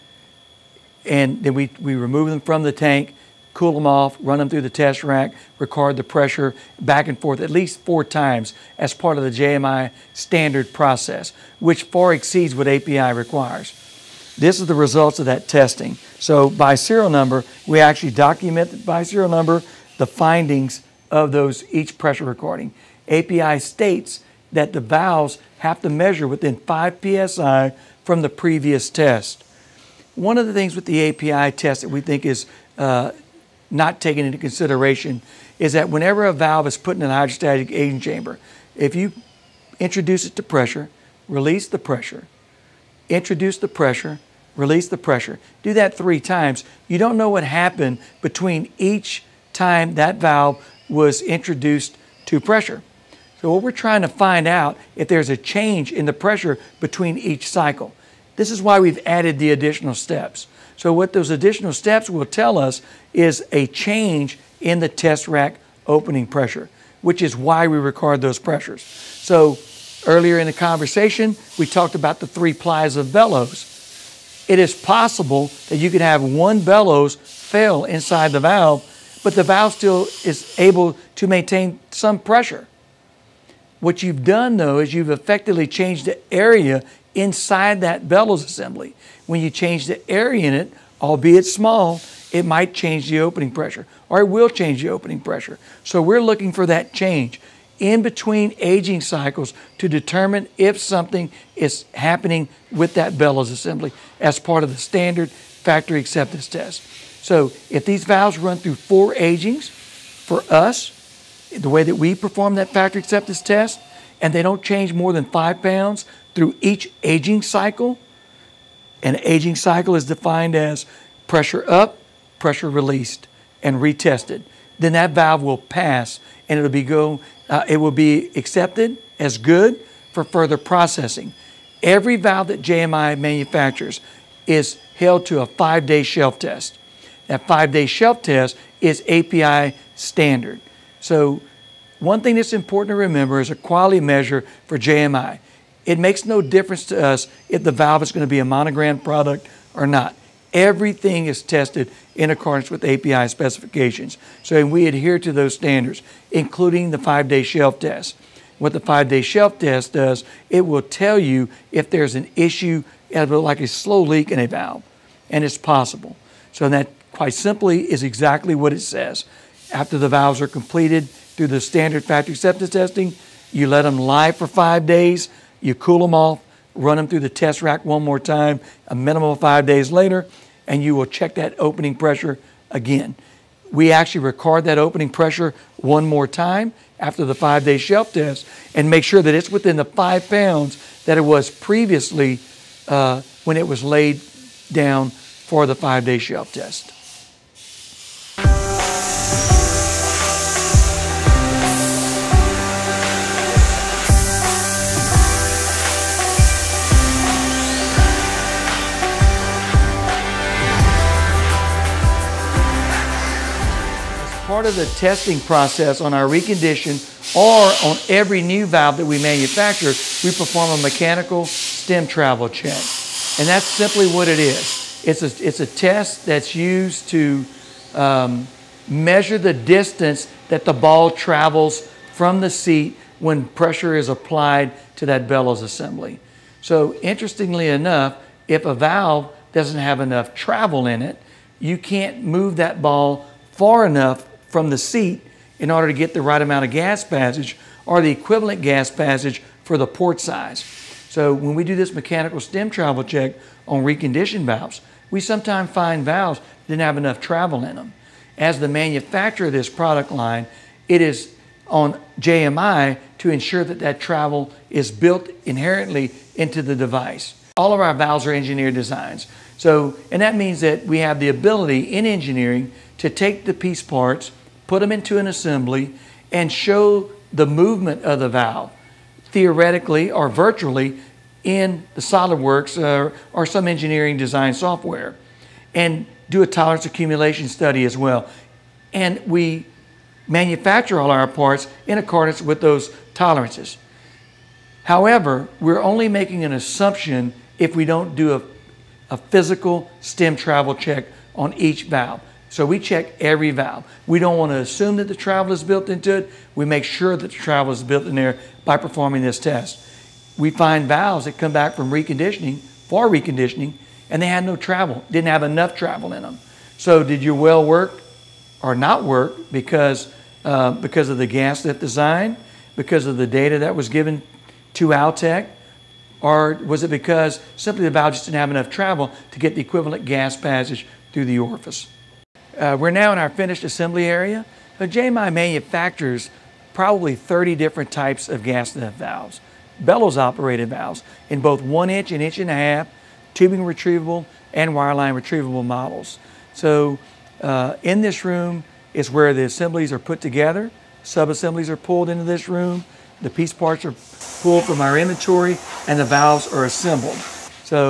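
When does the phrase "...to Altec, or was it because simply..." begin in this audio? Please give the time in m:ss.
5:24.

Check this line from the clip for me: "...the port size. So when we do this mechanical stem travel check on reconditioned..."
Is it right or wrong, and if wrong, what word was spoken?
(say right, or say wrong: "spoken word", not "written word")
right.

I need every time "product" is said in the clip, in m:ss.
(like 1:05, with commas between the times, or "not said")
2:28, 4:19.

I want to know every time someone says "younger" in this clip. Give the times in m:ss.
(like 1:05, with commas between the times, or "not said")
not said.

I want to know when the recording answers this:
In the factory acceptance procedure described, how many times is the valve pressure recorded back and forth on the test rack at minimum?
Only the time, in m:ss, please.
0:07.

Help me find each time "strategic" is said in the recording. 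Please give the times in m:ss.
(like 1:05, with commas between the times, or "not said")
not said.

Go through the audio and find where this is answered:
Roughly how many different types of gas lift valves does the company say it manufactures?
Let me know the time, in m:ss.
5:37.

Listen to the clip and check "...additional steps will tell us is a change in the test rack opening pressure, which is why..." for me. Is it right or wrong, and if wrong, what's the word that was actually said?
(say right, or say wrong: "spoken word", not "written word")
right.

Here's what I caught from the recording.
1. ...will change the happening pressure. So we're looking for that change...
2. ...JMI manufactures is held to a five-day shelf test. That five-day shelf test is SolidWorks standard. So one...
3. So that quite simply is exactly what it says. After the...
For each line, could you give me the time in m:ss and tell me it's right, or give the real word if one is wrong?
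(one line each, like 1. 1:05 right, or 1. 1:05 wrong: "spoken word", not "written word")
1. 1:34 wrong: "opening", not "happening"
2. 2:12 wrong: "API", not "SolidWorks"
3. 2:46 right.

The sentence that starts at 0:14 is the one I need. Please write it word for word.
This is the results of that testing.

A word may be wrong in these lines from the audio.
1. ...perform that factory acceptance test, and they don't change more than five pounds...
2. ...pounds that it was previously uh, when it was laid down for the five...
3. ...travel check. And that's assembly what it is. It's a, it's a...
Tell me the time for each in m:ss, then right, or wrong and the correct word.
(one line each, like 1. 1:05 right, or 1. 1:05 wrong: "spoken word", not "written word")
1. 1:52 right
2. 3:10 right
3. 3:42 wrong: "simply", not "assembly".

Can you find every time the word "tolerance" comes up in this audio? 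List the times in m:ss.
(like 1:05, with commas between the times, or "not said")
4:46, 4:53.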